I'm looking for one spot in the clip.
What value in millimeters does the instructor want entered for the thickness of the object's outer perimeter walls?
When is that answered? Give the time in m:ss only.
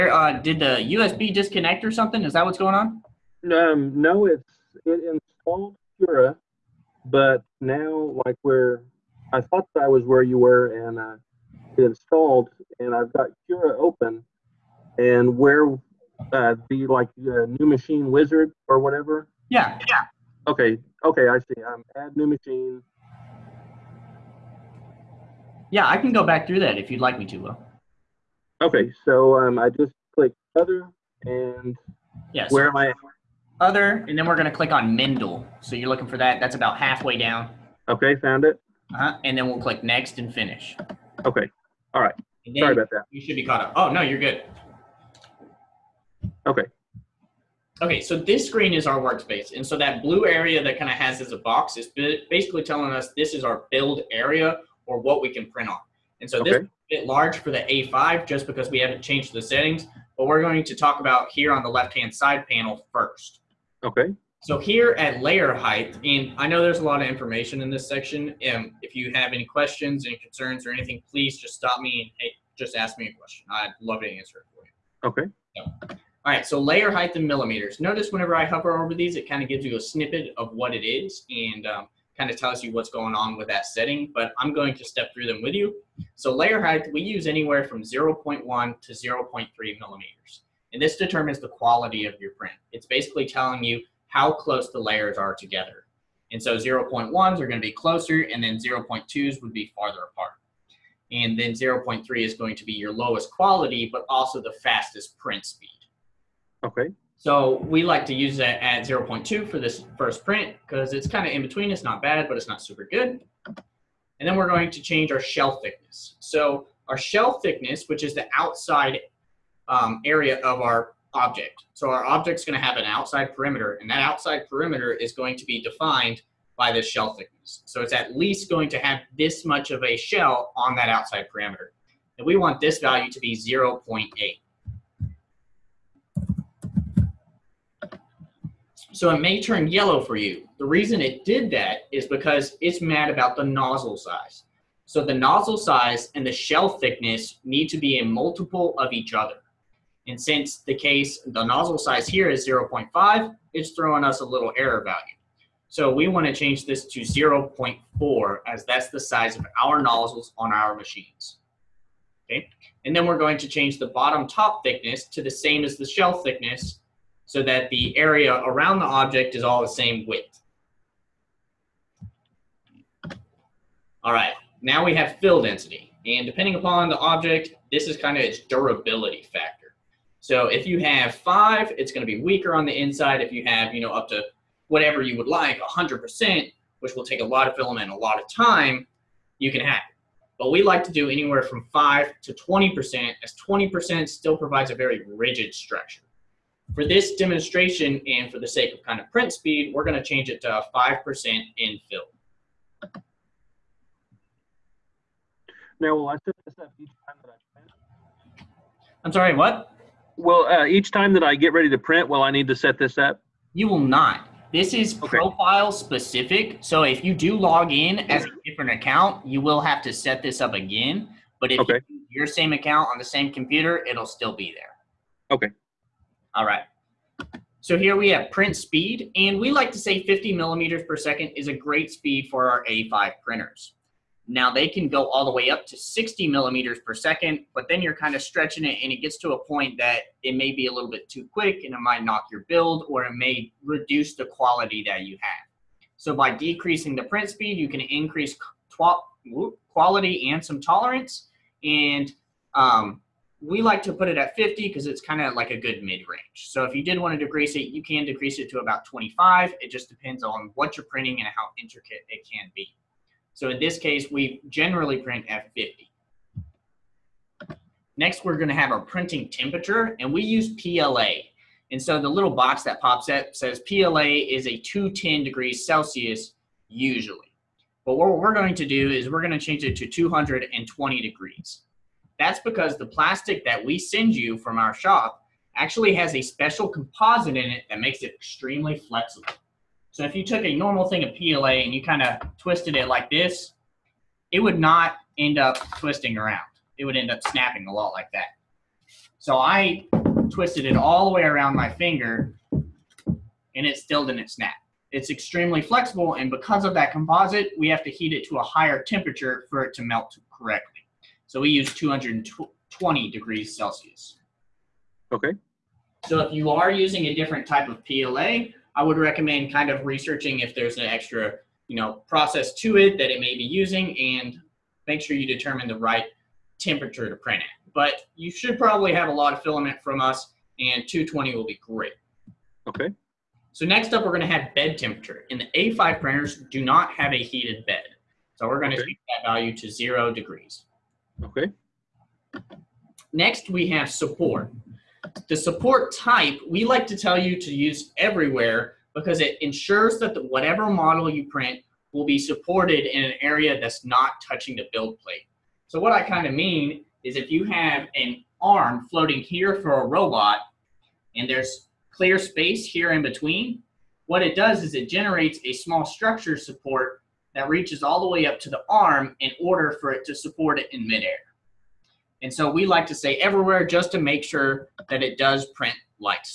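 2:13.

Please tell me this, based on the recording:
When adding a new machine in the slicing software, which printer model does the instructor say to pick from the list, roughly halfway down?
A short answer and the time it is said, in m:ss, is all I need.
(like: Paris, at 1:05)
Mendel, at 0:34.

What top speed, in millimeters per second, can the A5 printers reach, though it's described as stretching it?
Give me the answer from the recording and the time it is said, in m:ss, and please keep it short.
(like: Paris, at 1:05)
60 millimeters per second, at 3:55.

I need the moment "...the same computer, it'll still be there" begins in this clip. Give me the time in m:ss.
3:42.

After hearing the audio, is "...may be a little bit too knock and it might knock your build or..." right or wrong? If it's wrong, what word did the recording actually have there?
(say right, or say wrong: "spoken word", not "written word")
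wrong: "quick", not "knock".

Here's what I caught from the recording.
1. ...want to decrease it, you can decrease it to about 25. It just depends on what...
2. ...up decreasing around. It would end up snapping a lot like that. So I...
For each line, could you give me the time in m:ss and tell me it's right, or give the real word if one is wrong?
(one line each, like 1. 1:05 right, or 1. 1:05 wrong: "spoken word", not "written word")
1. 4:16 right
2. 4:55 wrong: "twisting", not "decreasing".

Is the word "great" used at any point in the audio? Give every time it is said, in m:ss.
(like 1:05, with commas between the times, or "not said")
3:51, 5:31.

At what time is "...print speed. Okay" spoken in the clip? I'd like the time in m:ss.
1:45.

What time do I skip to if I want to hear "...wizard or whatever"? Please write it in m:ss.
0:18.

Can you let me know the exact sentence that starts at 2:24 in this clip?
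So the nozzle size and the shell thickness need to be a multiple of each other.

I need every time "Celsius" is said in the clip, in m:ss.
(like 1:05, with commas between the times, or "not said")
4:35, 5:13.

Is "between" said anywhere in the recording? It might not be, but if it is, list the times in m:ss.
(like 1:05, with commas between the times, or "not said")
1:51, 6:03.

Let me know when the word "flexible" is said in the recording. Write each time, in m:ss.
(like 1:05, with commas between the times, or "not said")
4:48, 5:05.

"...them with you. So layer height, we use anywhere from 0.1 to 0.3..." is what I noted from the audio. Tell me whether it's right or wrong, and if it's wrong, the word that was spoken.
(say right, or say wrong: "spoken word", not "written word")
right.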